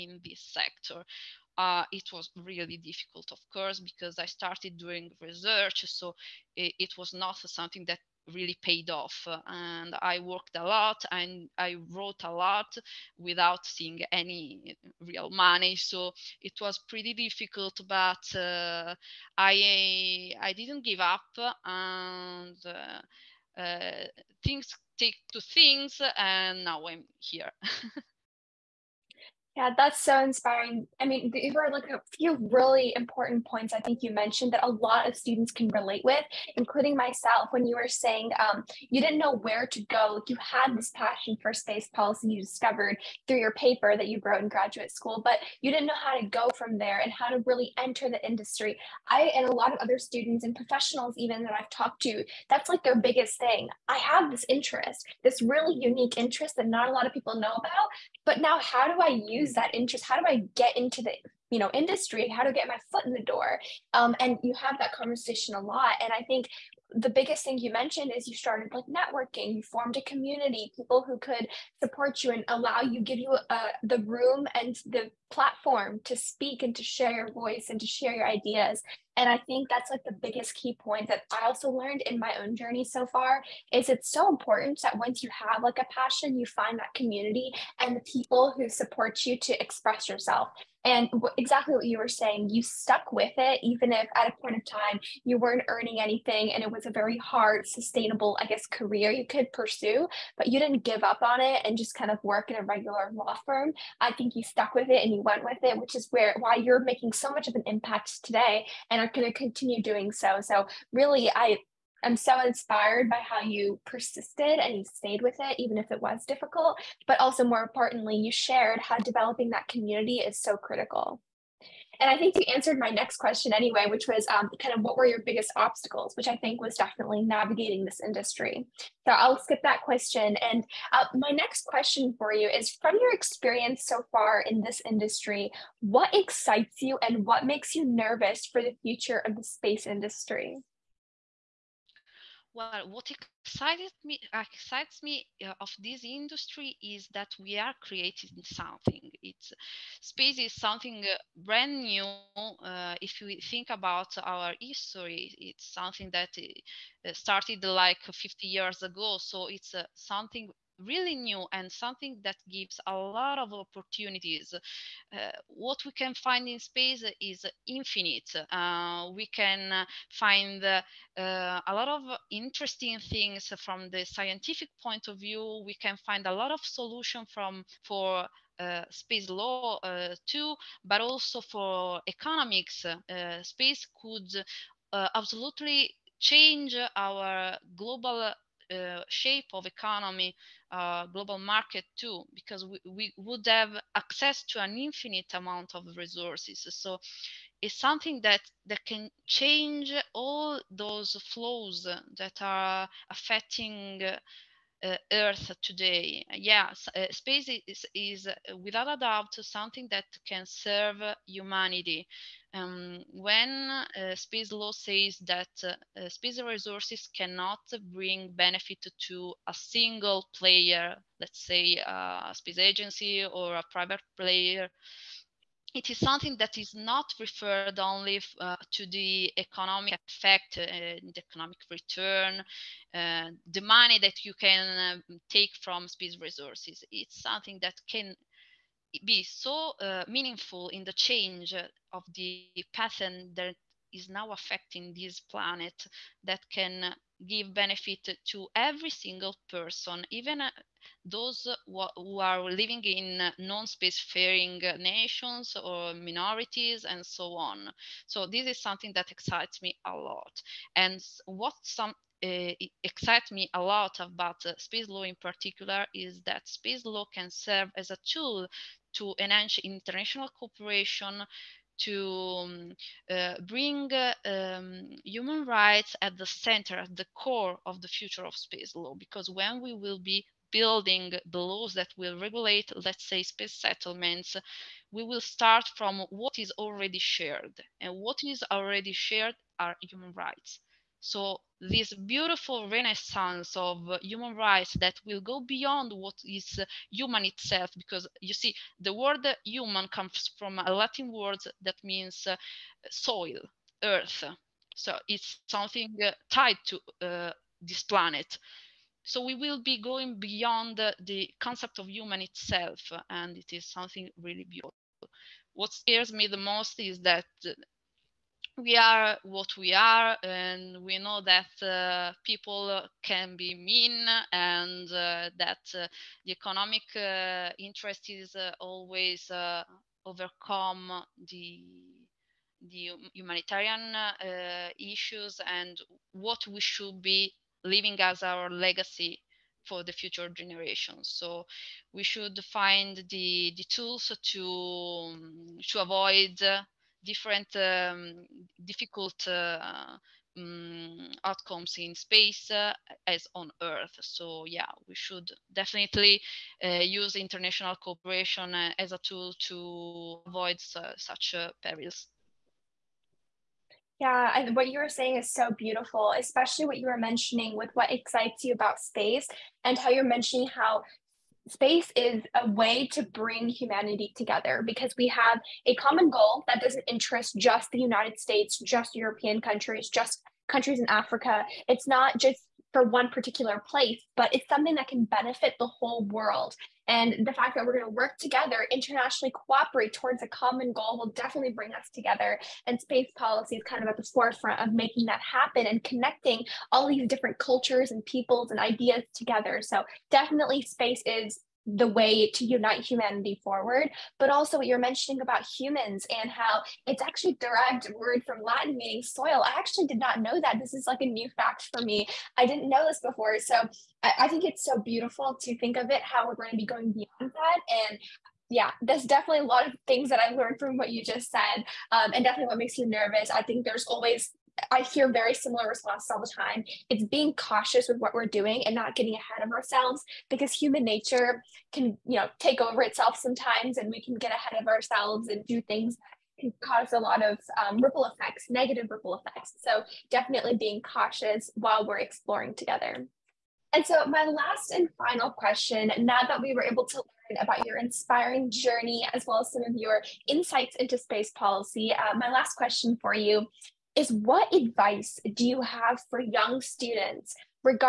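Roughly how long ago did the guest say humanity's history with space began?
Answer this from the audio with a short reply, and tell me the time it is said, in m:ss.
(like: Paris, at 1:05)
50 years ago, at 2:38.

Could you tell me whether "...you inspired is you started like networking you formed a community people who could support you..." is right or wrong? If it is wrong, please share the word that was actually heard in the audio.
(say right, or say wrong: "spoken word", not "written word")
wrong: "mentioned", not "inspired".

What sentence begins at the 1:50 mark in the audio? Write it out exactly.
So, really, I I'm so inspired by how you persisted and you stayed with it, even if it was difficult.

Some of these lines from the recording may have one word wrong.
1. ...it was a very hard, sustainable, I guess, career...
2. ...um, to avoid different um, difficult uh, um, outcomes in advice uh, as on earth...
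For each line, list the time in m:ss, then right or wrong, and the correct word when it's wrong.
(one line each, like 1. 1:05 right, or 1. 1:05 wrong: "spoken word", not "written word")
1. 1:36 right
2. 5:45 wrong: "space", not "advice".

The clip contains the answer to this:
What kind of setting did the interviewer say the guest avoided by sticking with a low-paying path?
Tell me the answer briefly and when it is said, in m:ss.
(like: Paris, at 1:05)
A regular law firm, at 1:42.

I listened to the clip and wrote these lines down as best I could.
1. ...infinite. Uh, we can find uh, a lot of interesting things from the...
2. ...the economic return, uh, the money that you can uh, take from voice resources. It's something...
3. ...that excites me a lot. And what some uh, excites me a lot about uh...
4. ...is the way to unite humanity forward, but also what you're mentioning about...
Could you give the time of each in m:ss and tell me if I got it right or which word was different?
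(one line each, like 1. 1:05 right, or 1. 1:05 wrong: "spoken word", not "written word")
1. 2:47 right
2. 3:50 wrong: "space", not "voice"
3. 4:18 right
4. 6:41 right.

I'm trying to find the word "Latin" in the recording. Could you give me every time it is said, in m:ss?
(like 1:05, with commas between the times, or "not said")
5:00, 6:48.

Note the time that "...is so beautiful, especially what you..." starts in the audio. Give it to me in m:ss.
6:05.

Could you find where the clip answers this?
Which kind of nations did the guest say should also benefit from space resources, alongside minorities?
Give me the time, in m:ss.
4:13.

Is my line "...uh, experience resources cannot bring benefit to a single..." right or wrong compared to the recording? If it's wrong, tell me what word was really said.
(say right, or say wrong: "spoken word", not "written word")
wrong: "space", not "experience".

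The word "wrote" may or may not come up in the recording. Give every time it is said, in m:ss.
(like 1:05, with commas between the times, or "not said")
0:11, 0:44.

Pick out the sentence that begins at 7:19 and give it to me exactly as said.
So definitely being cautious while we're exploring together.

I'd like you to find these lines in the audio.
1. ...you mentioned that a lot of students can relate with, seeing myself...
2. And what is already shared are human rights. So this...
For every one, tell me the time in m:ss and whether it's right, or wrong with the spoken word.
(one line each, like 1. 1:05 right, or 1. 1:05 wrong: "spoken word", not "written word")
1. 0:34 wrong: "including", not "seeing"
2. 4:47 right.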